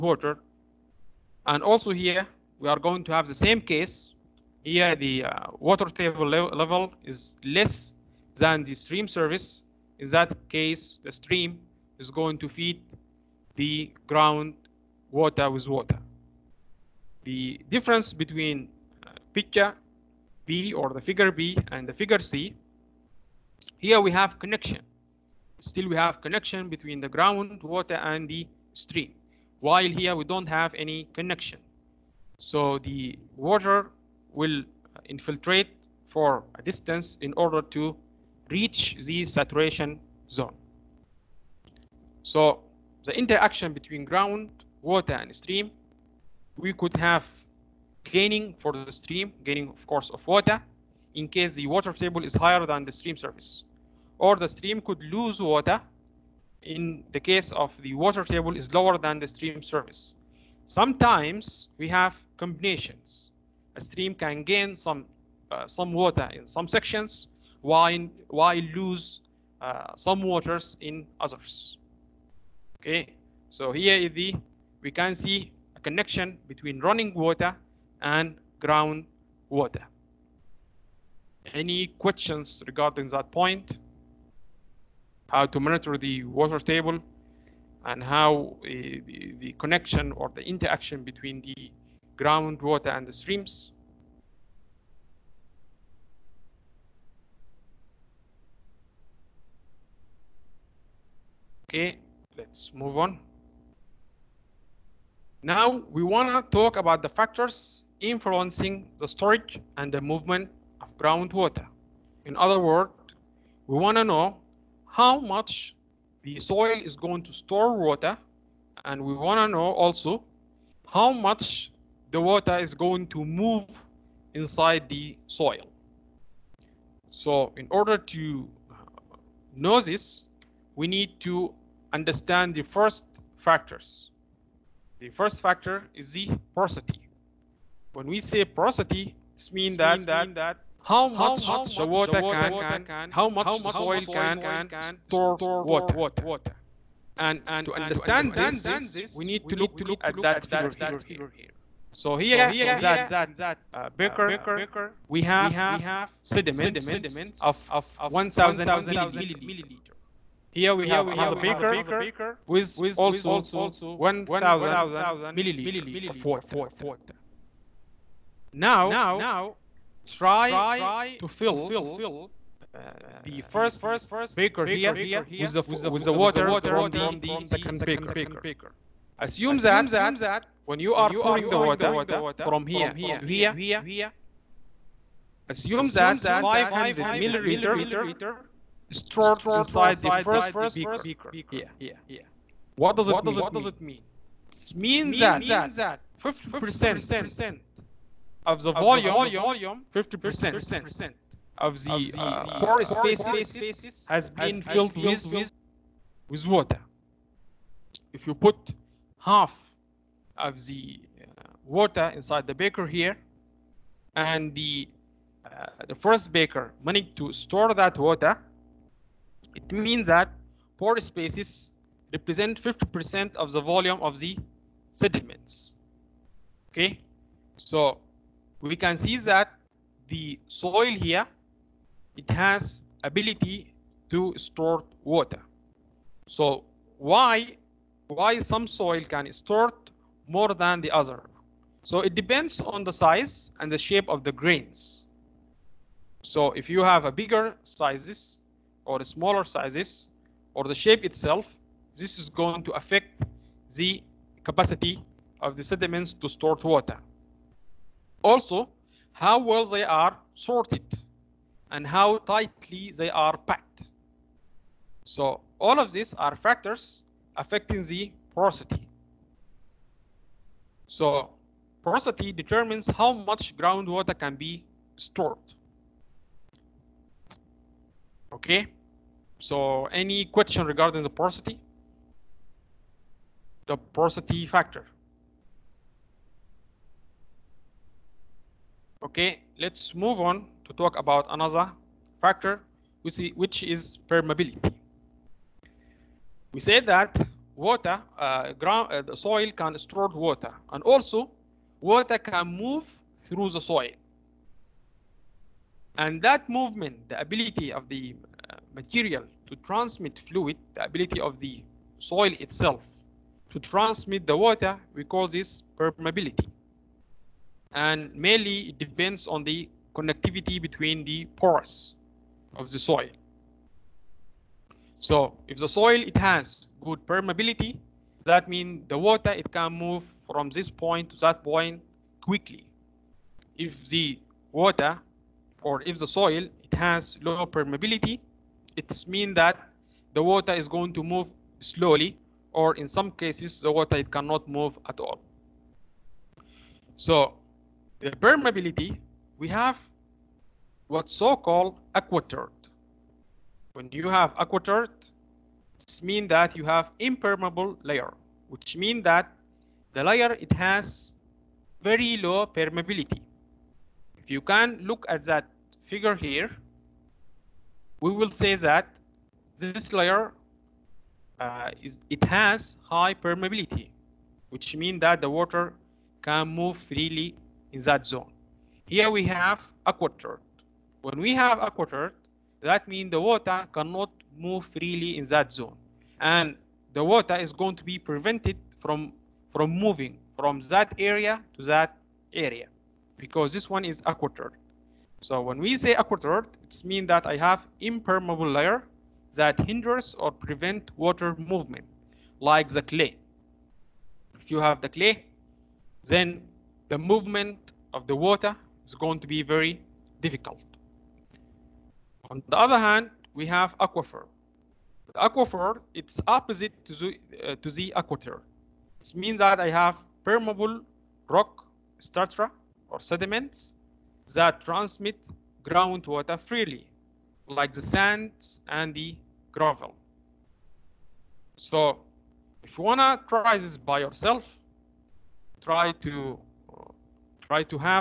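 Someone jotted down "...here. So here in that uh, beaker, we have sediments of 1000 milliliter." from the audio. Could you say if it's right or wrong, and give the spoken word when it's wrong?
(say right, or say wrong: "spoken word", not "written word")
right.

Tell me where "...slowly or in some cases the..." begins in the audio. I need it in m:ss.
5:41.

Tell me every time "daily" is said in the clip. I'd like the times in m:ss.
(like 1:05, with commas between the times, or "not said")
not said.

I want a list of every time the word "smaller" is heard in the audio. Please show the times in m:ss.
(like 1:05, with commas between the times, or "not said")
4:09.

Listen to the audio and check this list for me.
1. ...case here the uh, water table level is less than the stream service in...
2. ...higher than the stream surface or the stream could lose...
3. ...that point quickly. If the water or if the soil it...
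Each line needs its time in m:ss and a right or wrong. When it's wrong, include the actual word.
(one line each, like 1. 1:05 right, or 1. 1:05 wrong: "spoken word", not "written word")
1. 0:03 right
2. 0:52 right
3. 5:31 right.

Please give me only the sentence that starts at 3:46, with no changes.
Okay, so we can see that the soil here, it has ability to store water.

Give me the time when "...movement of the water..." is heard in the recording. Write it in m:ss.
6:46.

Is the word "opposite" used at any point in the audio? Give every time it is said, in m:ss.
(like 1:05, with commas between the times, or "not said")
6:56.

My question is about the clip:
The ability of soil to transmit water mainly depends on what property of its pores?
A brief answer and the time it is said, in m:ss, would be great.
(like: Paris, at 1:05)
connectivity, at 5:19.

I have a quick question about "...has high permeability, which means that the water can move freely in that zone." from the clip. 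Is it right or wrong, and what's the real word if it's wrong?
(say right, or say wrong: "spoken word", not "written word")
right.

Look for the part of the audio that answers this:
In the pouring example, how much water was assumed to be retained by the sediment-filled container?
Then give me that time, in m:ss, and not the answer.
3:06.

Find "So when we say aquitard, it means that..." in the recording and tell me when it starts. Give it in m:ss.
6:35.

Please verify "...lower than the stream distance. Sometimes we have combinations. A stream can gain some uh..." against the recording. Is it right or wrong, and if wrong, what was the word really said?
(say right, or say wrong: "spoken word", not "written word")
wrong: "surface", not "distance".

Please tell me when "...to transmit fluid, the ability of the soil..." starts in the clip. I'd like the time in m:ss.
5:09.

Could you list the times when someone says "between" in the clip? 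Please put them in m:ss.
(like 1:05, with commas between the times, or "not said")
0:18, 0:26, 0:43, 1:16, 1:31, 5:20.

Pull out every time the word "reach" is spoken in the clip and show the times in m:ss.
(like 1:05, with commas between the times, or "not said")
0:38.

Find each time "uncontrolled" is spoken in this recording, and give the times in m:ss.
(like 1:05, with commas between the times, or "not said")
not said.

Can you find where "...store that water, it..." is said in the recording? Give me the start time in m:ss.
3:37.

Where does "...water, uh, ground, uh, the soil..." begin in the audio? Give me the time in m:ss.
4:57.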